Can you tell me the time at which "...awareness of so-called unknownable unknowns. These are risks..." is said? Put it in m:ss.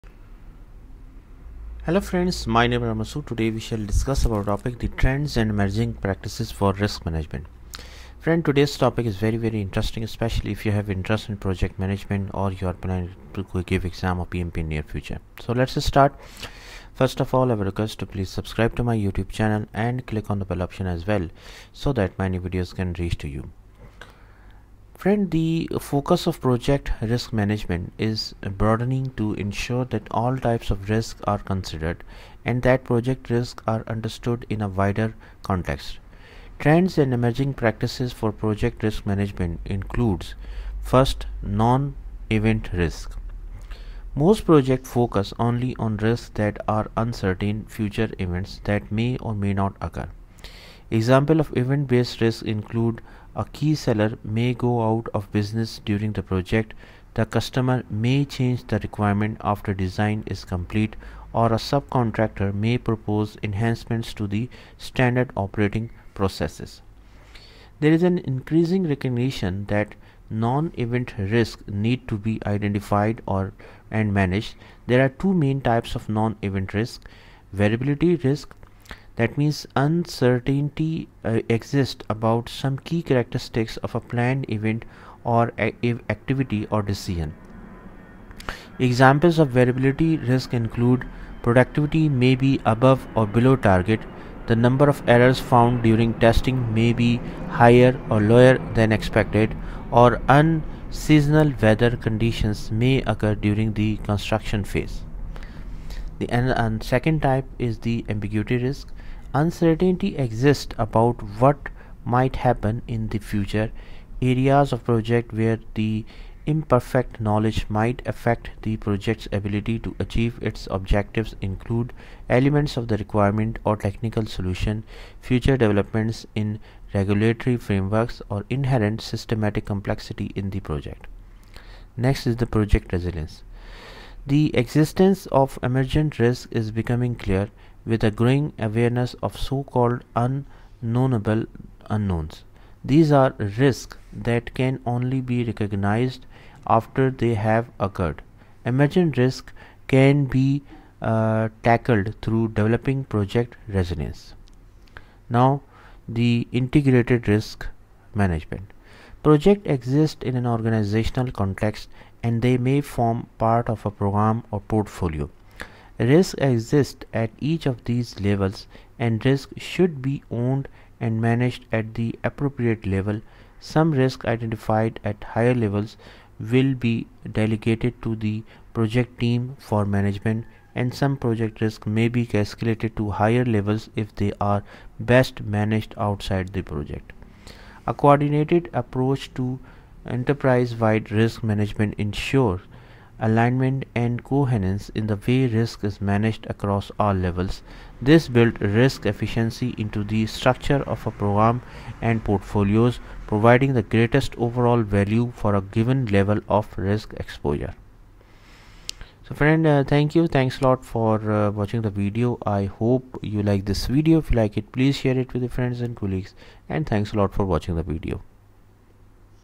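2:18.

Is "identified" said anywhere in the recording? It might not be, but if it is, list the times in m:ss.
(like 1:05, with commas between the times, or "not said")
1:12, 2:54.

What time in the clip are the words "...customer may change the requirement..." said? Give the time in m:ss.
0:57.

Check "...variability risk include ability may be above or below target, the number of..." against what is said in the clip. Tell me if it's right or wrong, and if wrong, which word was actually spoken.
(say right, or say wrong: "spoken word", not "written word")
wrong: "productivity", not "ability".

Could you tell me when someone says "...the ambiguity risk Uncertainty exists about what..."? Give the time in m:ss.
1:47.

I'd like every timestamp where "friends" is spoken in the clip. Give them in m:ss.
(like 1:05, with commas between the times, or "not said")
0:01, 0:08, 0:25, 3:29, 3:35.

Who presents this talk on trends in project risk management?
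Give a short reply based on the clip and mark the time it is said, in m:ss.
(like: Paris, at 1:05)
Ramasu, at 0:02.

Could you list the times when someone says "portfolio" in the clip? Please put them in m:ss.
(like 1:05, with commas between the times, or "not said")
2:44, 3:22.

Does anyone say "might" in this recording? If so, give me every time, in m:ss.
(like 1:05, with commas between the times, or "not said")
1:52, 1:57.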